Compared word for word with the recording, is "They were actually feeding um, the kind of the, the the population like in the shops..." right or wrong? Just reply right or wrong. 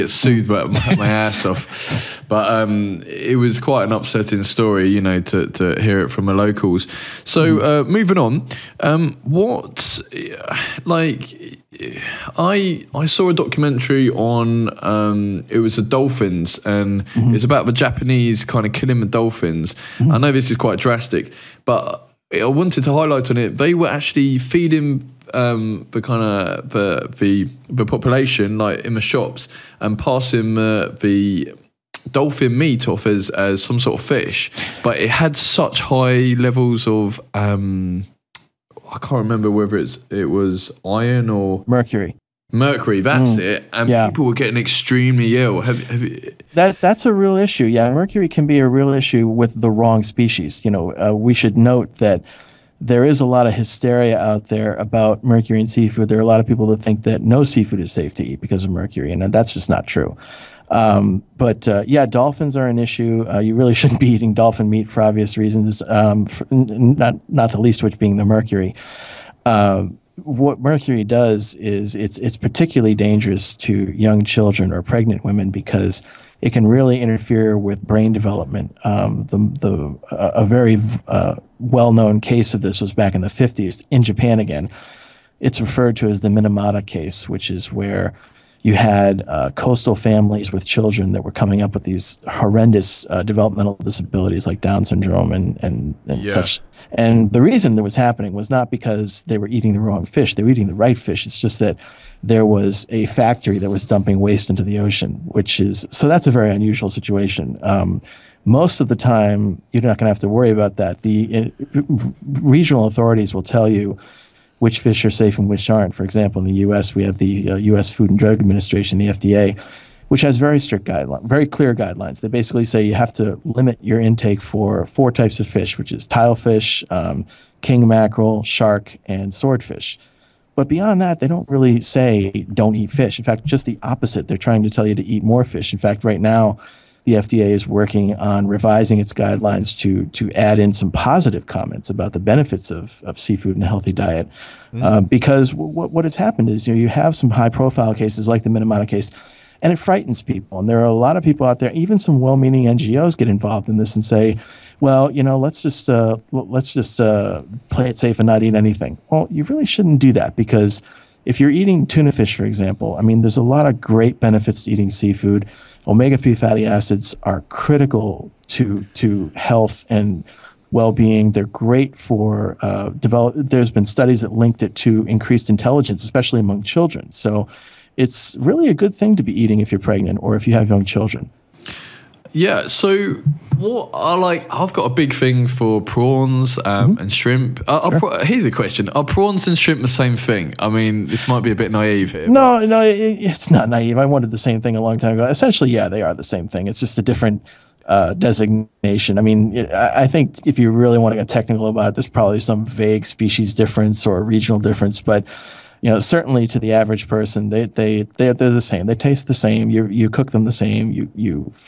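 right.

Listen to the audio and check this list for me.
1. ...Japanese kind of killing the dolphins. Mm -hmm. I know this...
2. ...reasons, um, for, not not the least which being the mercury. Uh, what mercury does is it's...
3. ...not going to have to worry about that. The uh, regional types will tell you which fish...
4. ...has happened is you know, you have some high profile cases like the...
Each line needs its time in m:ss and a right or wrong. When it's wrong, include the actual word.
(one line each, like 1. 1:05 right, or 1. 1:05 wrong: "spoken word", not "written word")
1. 0:17 right
2. 1:05 right
3. 1:49 wrong: "authorities", not "types"
4. 2:26 right.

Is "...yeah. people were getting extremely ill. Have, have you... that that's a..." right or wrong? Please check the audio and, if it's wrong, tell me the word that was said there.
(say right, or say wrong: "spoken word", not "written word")
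right.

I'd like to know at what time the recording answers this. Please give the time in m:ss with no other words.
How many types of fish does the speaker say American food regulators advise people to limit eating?
2:04.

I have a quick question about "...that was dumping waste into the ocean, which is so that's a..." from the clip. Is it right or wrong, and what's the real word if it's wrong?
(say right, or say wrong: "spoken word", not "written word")
right.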